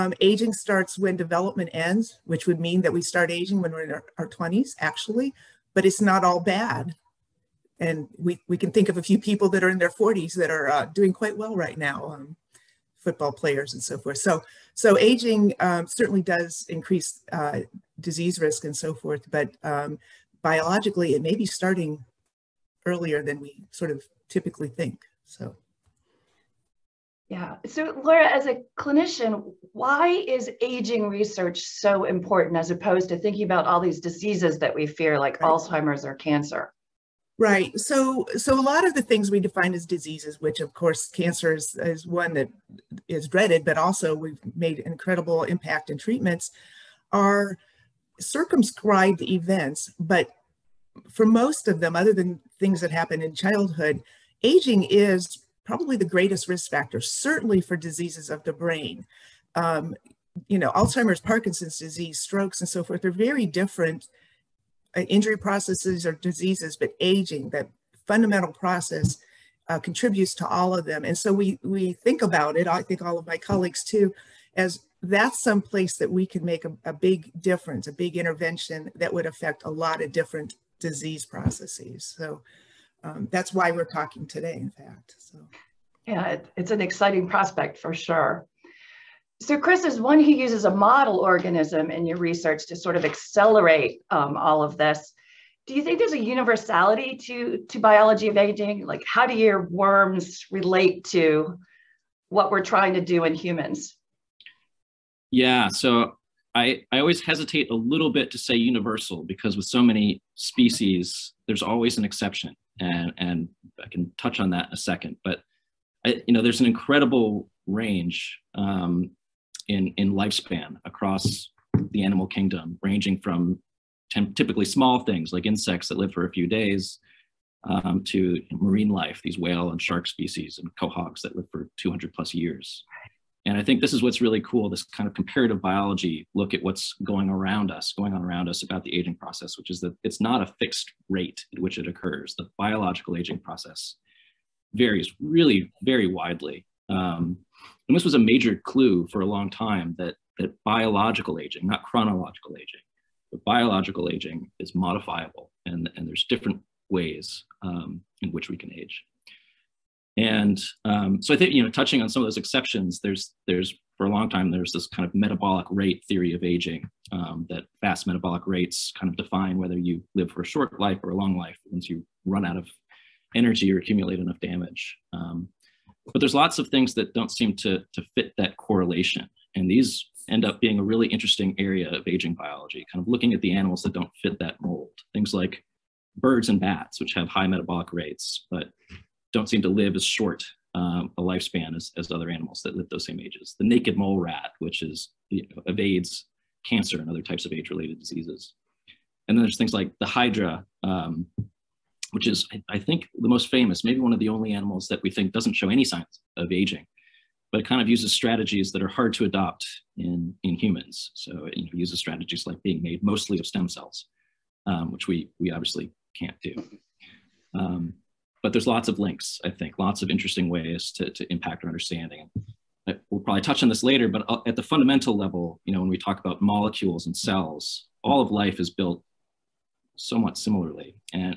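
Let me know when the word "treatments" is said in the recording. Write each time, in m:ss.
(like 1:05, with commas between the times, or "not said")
0:45.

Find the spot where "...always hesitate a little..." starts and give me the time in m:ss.
1:47.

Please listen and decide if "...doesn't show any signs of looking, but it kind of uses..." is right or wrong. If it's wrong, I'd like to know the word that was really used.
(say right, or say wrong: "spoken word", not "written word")
wrong: "aging", not "looking".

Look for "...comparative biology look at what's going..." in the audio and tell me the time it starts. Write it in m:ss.
2:15.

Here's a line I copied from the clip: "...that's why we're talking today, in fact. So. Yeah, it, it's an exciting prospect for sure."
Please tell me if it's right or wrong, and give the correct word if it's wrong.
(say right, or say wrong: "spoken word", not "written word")
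right.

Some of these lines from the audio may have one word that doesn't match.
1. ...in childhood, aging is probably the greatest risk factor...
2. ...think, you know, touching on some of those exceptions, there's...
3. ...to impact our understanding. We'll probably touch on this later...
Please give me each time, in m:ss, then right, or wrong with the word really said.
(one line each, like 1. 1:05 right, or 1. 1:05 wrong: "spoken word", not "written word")
1. 0:53 right
2. 2:41 right
3. 3:41 right.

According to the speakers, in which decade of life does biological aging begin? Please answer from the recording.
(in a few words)
20s.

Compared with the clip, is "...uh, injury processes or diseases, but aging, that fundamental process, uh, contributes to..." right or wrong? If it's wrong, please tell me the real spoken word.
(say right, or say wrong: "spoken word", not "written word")
right.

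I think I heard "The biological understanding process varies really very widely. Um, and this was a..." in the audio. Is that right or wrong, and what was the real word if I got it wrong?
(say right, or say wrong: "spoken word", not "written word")
wrong: "aging", not "understanding".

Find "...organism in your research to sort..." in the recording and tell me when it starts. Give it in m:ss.
1:31.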